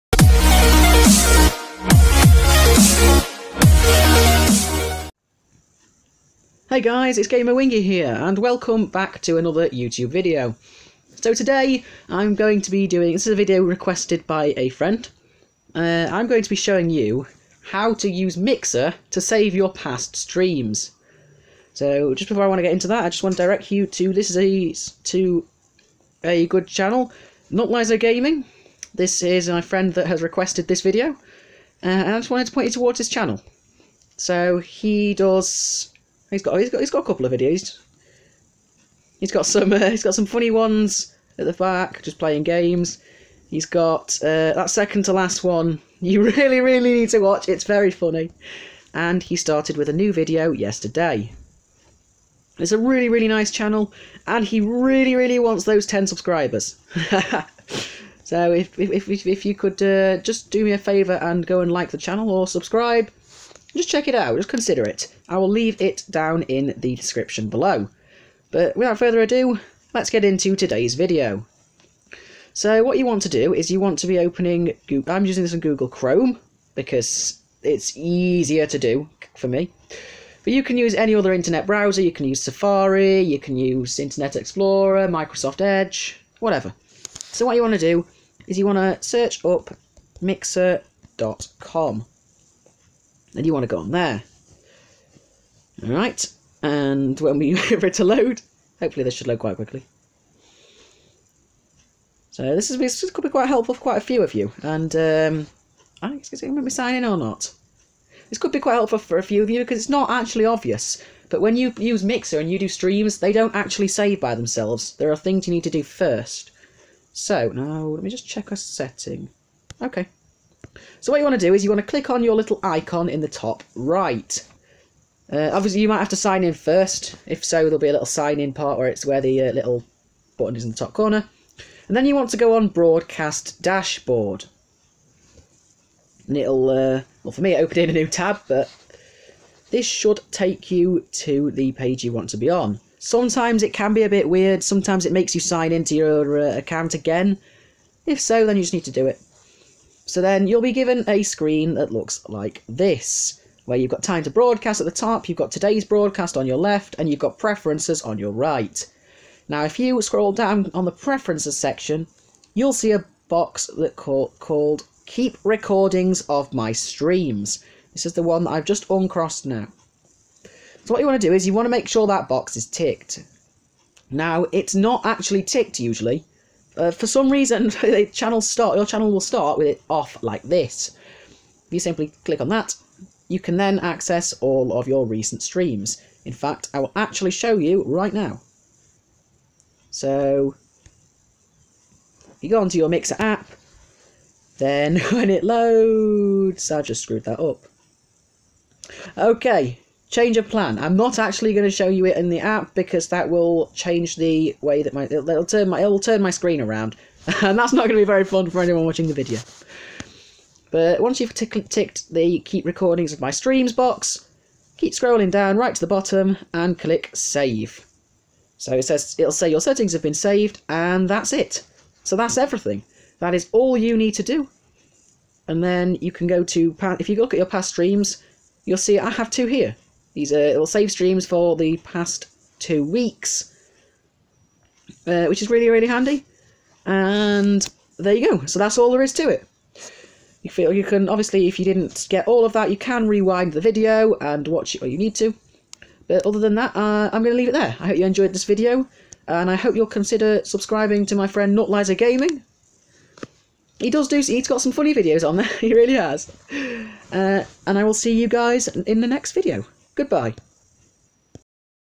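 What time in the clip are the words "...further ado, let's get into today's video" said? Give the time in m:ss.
1:08.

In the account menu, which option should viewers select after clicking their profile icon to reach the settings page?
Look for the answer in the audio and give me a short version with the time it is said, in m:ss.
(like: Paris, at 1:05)
Broadcast Dashboard, at 2:12.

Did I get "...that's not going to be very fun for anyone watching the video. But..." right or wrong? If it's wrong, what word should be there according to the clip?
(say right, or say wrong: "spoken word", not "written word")
right.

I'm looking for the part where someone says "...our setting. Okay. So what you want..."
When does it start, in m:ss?
1:58.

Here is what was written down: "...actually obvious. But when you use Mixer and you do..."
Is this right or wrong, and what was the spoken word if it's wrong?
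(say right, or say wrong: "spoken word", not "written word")
right.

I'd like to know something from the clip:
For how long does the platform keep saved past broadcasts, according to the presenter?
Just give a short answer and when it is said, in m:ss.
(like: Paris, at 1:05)
2 weeks, at 3:52.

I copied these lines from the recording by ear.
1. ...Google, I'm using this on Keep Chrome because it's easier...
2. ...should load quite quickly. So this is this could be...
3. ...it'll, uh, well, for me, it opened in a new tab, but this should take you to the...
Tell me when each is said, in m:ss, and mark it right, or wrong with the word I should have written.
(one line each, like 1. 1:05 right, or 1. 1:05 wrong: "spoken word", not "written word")
1. 1:14 wrong: "Google", not "Keep"
2. 1:39 right
3. 2:16 right.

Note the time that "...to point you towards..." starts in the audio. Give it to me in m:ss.
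0:32.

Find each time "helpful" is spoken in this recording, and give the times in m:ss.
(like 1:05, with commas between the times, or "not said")
1:43, 1:48.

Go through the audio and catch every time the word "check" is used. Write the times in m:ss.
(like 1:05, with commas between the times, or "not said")
1:03, 1:58.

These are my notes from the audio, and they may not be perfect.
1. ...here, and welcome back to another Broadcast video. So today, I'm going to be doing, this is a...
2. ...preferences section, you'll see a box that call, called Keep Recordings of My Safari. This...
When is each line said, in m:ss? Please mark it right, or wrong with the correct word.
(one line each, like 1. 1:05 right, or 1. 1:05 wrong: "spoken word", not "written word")
1. 0:07 wrong: "YouTube", not "Broadcast"
2. 2:40 wrong: "Streams", not "Safari".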